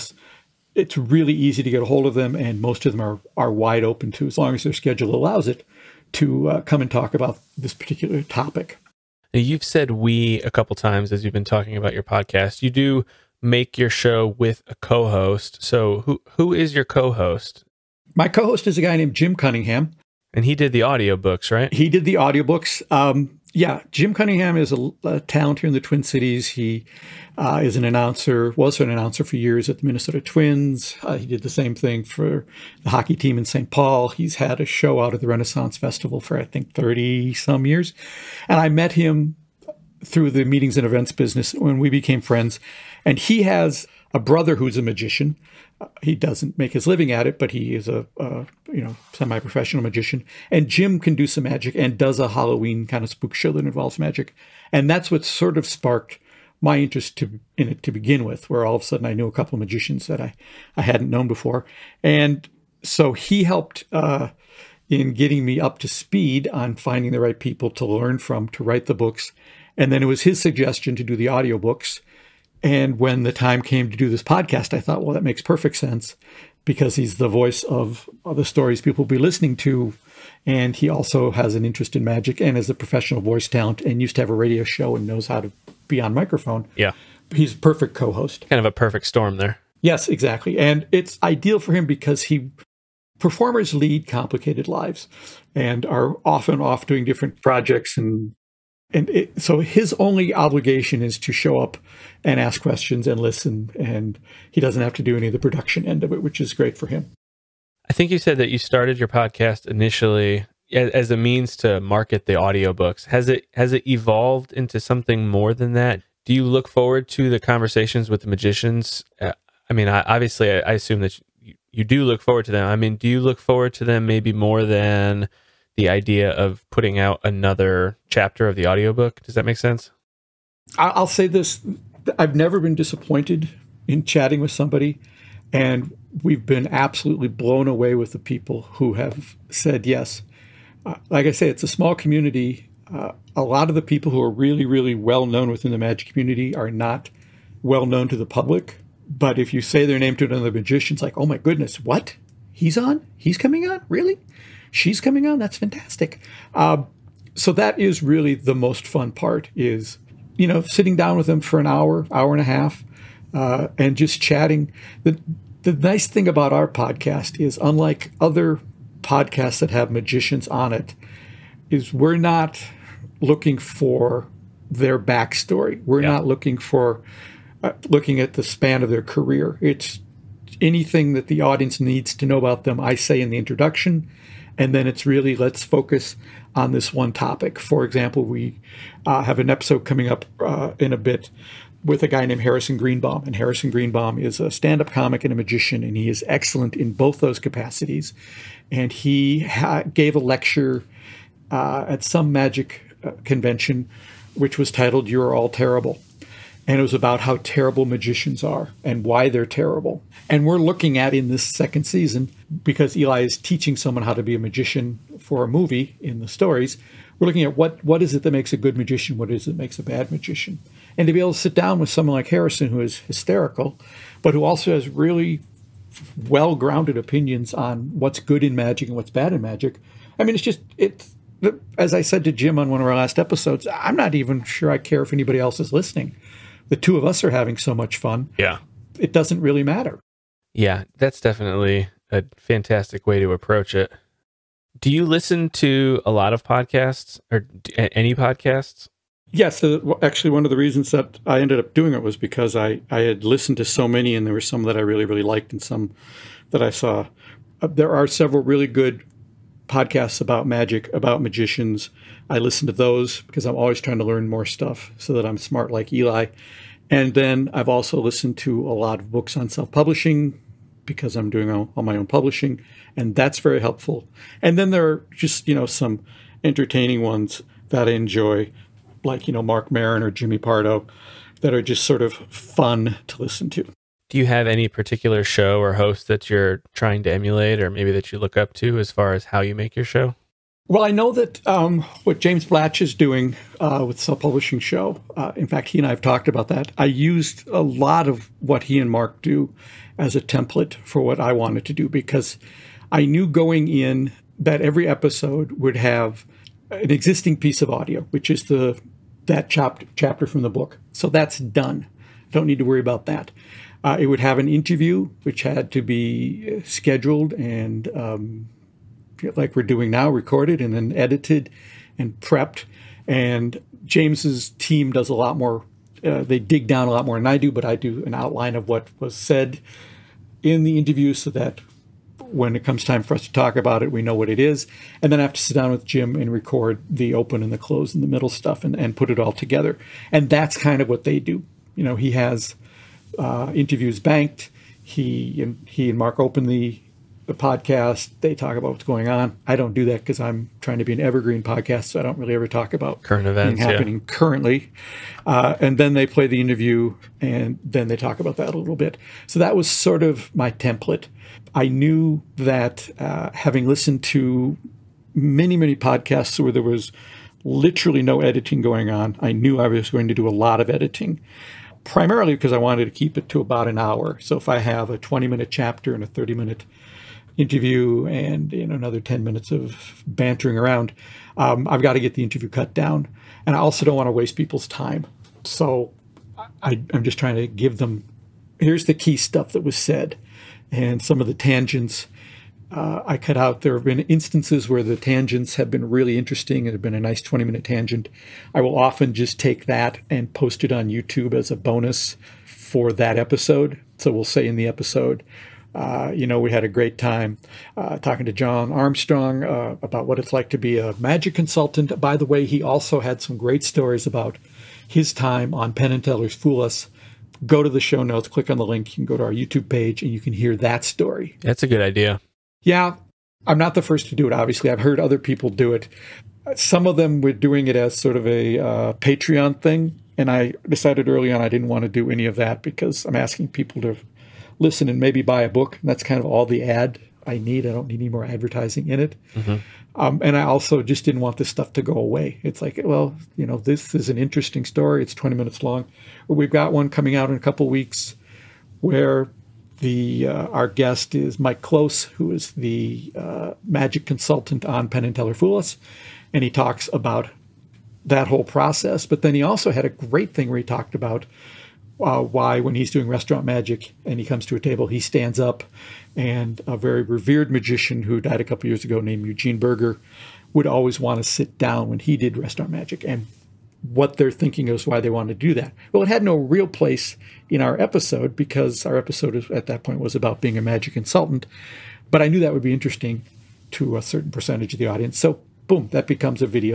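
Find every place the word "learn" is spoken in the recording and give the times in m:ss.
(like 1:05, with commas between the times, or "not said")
1:07, 4:24.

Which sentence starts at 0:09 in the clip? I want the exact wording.
Now, you've said we a couple times as you've been talking about your podcast.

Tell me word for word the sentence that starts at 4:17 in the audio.
Uh, there are several really good podcasts about magic, about magicians.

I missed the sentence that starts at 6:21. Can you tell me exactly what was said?
Um, I've got to get the interview cut down.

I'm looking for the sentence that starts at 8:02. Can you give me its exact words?
But I knew that would be interesting to a certain percentage of the audience.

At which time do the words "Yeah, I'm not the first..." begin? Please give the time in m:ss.
7:02.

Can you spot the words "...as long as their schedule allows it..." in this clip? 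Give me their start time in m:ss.
0:04.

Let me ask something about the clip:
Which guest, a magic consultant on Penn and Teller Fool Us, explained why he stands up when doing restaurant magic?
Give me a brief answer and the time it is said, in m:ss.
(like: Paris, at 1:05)
Mike Close, at 7:31.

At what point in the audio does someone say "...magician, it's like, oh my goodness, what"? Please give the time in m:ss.
2:30.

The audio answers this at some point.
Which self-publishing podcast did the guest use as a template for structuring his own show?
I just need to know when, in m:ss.
4:53.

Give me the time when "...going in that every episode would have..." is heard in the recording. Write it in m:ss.
5:03.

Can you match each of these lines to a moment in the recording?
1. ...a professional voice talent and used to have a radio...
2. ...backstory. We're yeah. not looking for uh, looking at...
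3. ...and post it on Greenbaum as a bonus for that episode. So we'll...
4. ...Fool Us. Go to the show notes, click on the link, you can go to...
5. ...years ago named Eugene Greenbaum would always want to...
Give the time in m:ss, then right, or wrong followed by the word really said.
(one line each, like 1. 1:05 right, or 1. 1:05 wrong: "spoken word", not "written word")
1. 1:22 right
2. 2:54 right
3. 6:40 wrong: "YouTube", not "Greenbaum"
4. 6:56 right
5. 7:48 wrong: "Burger", not "Greenbaum".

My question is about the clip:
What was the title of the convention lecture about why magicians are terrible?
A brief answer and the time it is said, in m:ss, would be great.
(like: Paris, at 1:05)
You're All Terrible, at 3:25.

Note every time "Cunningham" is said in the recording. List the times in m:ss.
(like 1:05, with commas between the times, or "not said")
0:19, 0:24.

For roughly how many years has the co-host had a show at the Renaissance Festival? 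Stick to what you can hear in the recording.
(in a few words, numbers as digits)
30 some years.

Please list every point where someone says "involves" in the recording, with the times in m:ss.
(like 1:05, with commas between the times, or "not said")
0:53.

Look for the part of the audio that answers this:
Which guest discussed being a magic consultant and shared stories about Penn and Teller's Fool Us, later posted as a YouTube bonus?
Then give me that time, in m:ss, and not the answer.
6:48.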